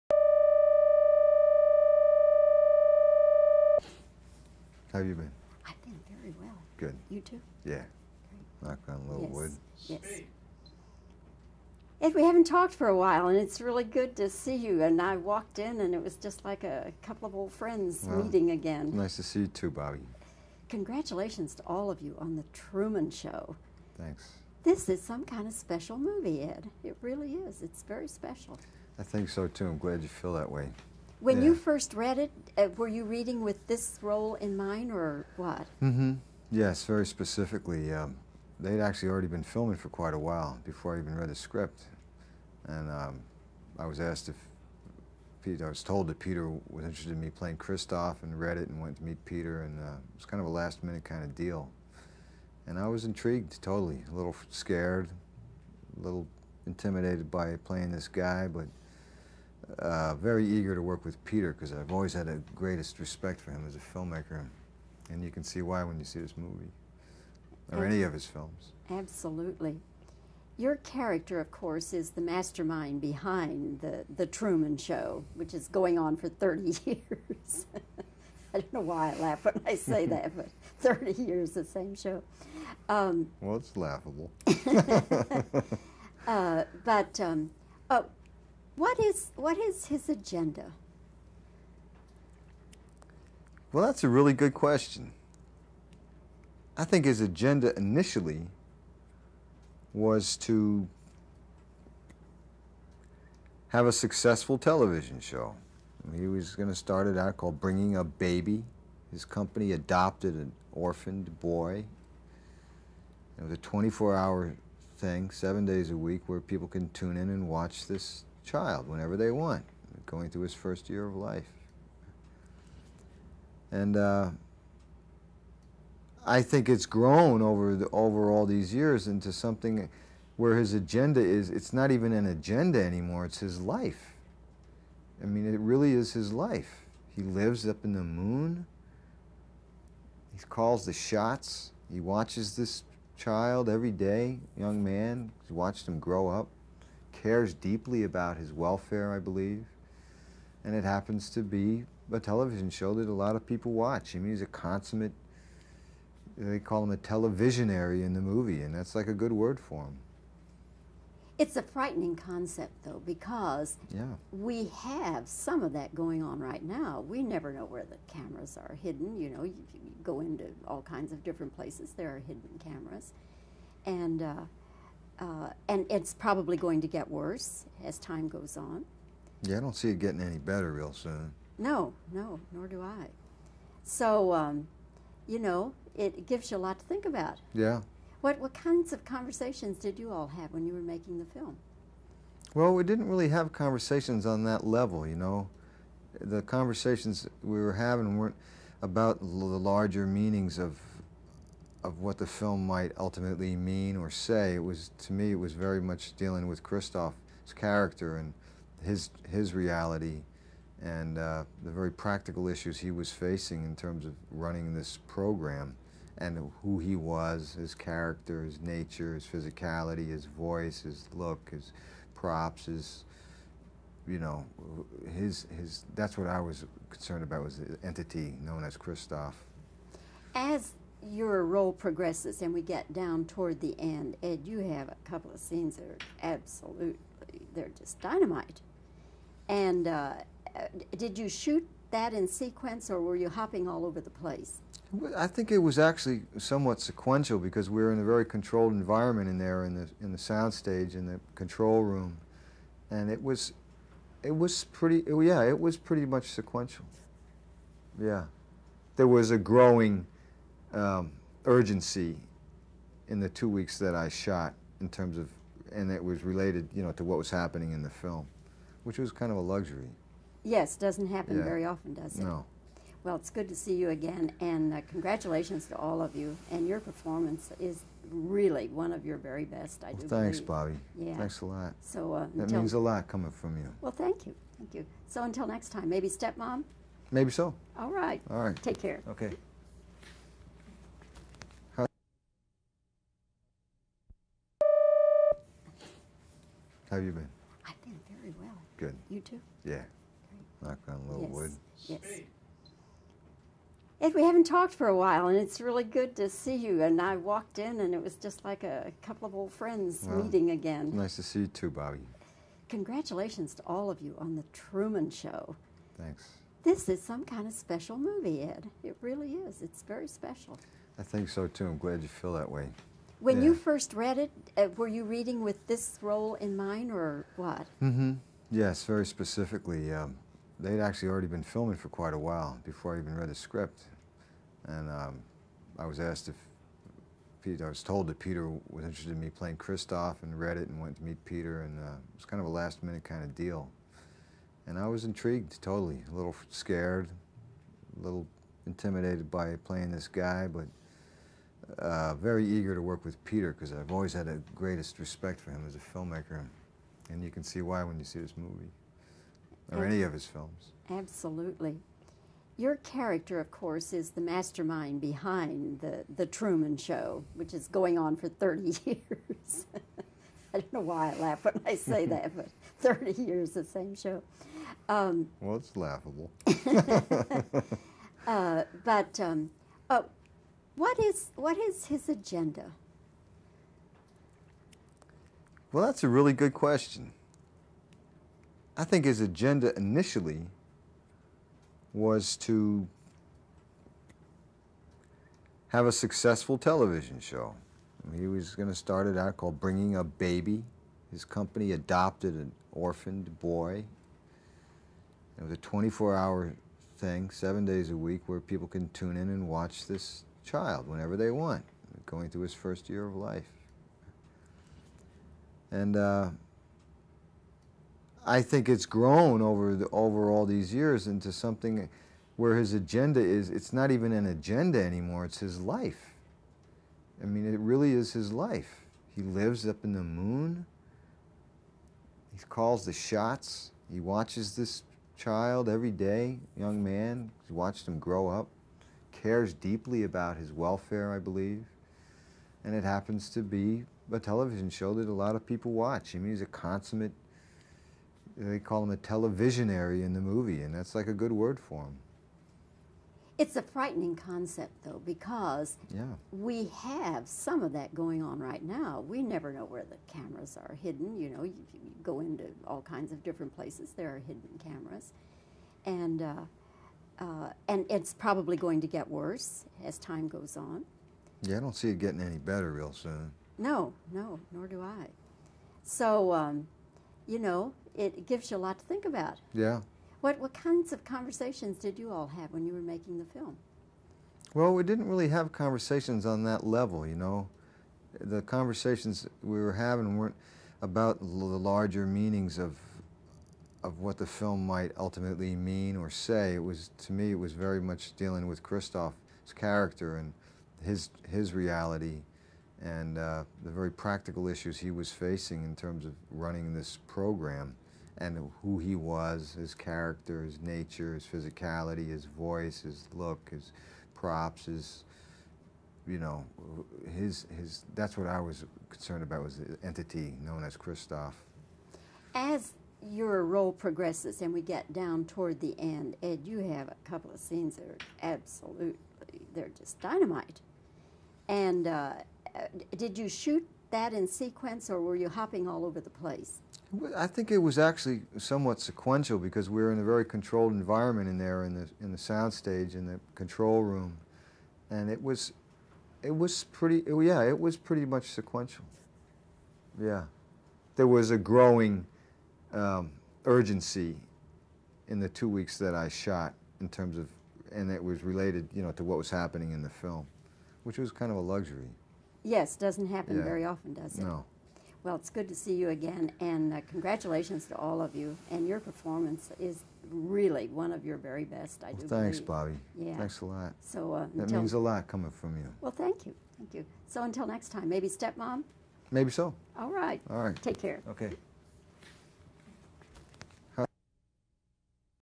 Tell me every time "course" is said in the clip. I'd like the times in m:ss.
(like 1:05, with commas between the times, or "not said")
1:11, 6:03.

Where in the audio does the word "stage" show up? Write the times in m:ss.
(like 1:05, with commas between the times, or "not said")
4:10, 9:02.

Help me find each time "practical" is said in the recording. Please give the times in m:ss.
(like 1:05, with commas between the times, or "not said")
3:31, 8:23.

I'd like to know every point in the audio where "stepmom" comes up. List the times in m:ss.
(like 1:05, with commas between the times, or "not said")
4:46, 9:38.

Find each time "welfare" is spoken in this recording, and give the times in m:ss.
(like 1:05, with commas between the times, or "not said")
2:28, 7:20.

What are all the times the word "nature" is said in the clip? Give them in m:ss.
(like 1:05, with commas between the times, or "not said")
3:38, 8:30.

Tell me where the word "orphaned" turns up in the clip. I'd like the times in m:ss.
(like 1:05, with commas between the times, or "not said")
1:50, 6:42.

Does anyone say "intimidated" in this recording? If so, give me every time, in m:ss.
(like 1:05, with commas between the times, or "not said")
0:56, 5:48.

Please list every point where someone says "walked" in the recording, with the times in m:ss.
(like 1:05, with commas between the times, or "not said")
0:15, 5:07.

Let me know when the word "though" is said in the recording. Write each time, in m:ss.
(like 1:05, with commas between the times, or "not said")
2:42, 7:34.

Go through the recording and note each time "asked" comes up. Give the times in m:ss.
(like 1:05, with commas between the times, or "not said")
0:43, 5:35.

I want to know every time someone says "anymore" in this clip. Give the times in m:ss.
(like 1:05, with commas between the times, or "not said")
2:12, 7:04.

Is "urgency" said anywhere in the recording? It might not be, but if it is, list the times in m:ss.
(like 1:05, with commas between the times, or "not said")
4:21, 9:13.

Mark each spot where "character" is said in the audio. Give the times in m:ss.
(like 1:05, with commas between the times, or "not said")
1:10, 3:27, 3:37, 6:02, 8:19, 8:29.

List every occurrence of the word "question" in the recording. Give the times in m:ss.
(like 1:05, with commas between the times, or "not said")
1:34, 6:26.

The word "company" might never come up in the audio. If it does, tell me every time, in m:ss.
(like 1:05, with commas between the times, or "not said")
1:49, 6:41.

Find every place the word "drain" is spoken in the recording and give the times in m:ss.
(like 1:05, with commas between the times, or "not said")
not said.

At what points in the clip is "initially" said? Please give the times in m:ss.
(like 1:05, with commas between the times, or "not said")
1:37, 6:29.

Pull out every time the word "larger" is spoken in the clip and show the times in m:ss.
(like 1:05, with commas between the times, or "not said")
3:19, 8:11.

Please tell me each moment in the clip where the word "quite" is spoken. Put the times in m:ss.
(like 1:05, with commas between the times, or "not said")
0:39, 5:31.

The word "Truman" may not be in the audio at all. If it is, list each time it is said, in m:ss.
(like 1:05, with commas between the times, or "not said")
0:22, 1:14, 5:14, 6:06.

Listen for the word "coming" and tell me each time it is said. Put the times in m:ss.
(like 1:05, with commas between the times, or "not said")
4:43, 9:35.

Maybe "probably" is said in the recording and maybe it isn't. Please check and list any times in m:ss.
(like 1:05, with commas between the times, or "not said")
2:56, 7:48.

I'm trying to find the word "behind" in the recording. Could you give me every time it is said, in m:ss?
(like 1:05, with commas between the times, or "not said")
1:13, 6:05.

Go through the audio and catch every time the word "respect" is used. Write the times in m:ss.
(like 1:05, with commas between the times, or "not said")
1:02, 5:54.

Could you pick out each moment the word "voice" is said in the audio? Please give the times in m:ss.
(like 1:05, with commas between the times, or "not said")
3:40, 8:32.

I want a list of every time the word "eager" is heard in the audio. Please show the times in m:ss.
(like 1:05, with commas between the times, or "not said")
1:00, 5:52.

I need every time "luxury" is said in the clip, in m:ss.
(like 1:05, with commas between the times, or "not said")
4:29, 9:21.